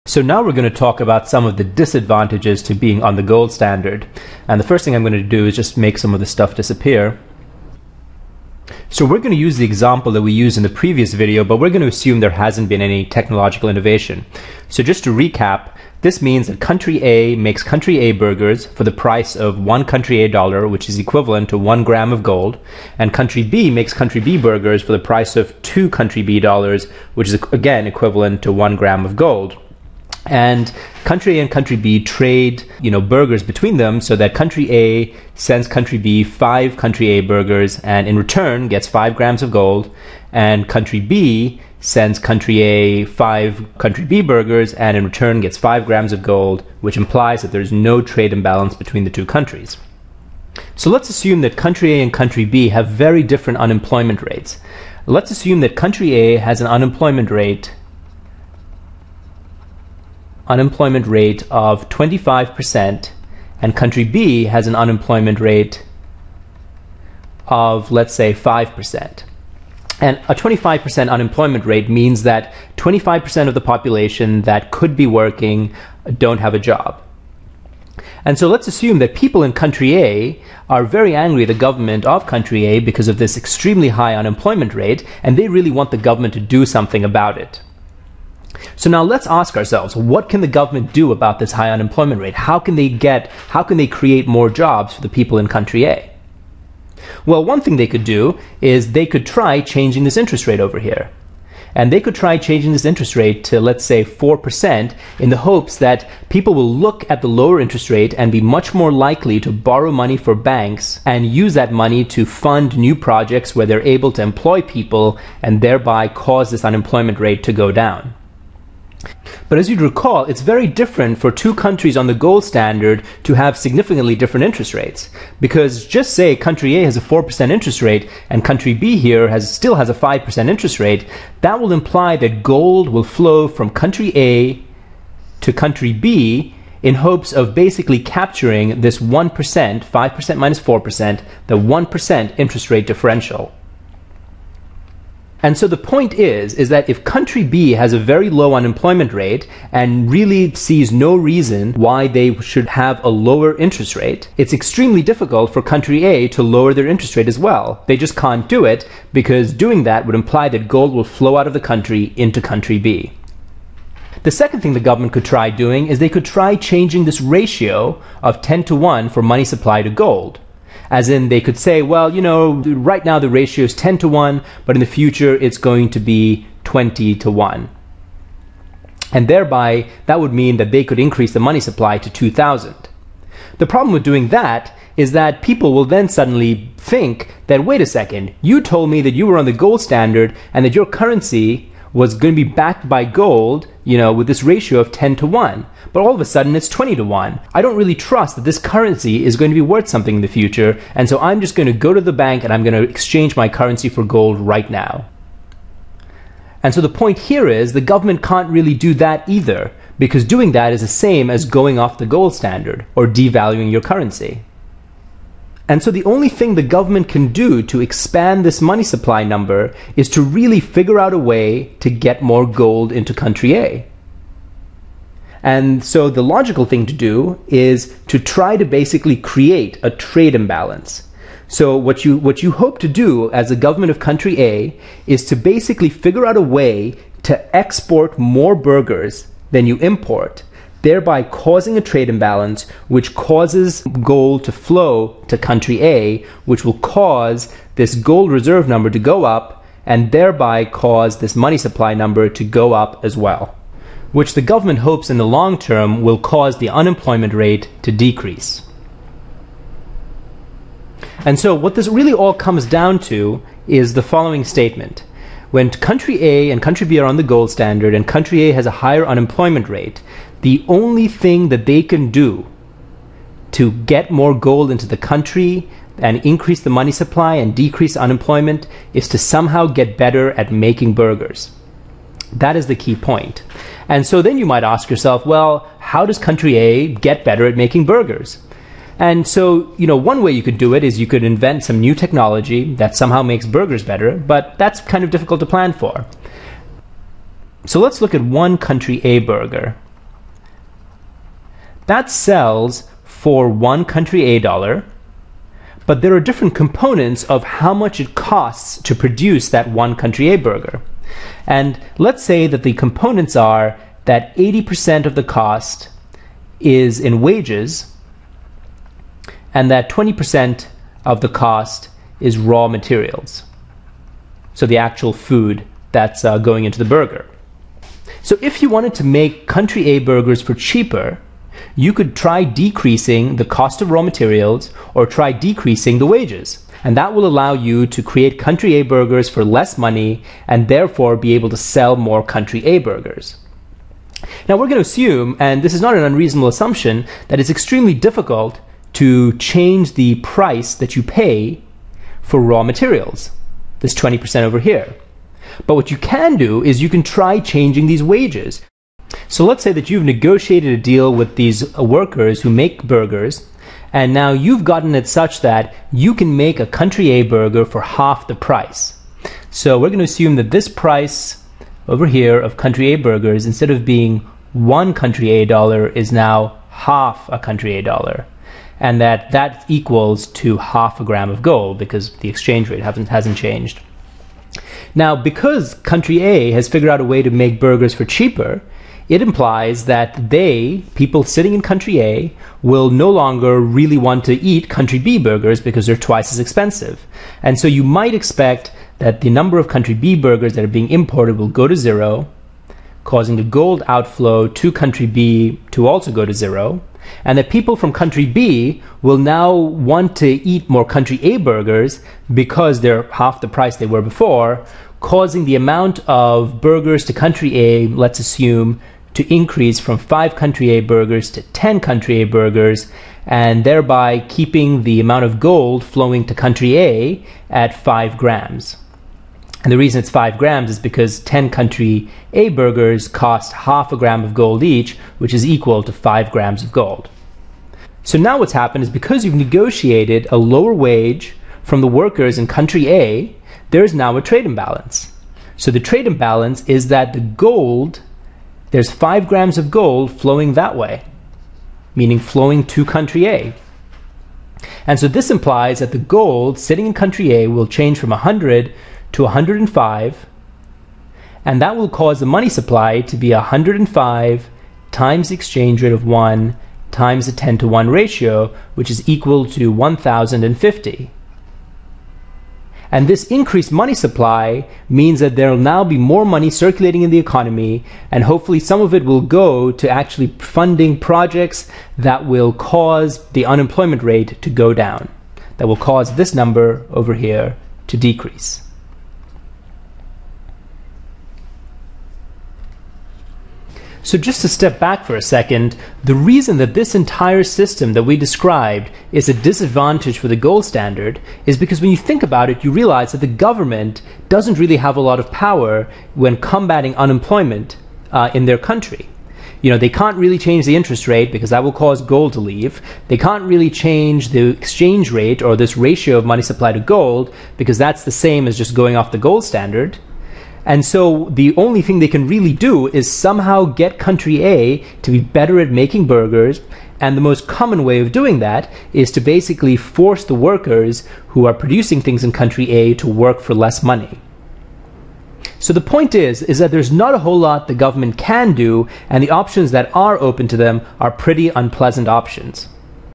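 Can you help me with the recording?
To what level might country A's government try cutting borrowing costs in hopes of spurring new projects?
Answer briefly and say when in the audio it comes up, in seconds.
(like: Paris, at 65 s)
4%, at 104 s.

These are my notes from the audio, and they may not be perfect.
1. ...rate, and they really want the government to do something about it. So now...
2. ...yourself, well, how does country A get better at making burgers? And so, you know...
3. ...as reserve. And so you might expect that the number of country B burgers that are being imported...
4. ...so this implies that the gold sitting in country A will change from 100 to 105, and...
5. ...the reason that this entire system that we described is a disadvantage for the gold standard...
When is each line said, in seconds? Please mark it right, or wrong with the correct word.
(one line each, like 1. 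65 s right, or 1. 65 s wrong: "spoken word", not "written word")
1. 84 s right
2. 284 s right
3. 396 s wrong: "expensive", not "reserve"
4. 454 s right
5. 496 s right.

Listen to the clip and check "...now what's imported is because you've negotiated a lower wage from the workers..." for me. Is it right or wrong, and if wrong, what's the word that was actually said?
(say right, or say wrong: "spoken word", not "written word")
wrong: "happened", not "imported".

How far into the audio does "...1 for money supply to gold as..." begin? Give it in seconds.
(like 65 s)
168 s.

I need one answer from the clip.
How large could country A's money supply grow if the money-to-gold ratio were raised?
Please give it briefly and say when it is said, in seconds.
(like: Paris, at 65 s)
2,000, at 182 s.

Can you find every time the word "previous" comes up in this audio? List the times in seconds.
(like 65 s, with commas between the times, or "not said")
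10 s.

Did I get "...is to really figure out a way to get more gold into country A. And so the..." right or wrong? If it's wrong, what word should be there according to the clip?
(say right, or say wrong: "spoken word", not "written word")
right.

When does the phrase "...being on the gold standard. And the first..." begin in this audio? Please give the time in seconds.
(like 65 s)
2 s.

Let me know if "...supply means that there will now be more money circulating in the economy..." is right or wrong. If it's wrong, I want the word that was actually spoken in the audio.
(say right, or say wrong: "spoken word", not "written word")
right.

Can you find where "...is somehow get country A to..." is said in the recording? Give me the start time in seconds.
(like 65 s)
522 s.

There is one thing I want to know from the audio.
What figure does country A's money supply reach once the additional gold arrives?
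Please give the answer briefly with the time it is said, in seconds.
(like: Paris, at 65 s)
1050, at 469 s.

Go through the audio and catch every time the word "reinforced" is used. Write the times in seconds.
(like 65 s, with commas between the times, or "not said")
not said.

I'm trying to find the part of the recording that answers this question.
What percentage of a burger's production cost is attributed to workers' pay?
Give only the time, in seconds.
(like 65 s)
314 s.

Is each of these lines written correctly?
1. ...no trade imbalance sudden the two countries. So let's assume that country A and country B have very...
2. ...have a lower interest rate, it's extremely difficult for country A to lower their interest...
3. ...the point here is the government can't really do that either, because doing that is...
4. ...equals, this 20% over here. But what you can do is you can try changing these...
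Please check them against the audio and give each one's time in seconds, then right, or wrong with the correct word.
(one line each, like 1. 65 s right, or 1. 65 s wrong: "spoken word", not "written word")
1. 47 s wrong: "between", not "sudden"
2. 152 s right
3. 206 s right
4. 352 s wrong: "materials", not "equals".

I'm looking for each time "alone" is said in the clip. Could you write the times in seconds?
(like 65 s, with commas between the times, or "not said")
not said.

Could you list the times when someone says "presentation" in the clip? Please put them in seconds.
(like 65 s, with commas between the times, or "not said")
not said.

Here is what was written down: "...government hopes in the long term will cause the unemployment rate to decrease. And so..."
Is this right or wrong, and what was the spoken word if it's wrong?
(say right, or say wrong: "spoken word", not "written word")
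right.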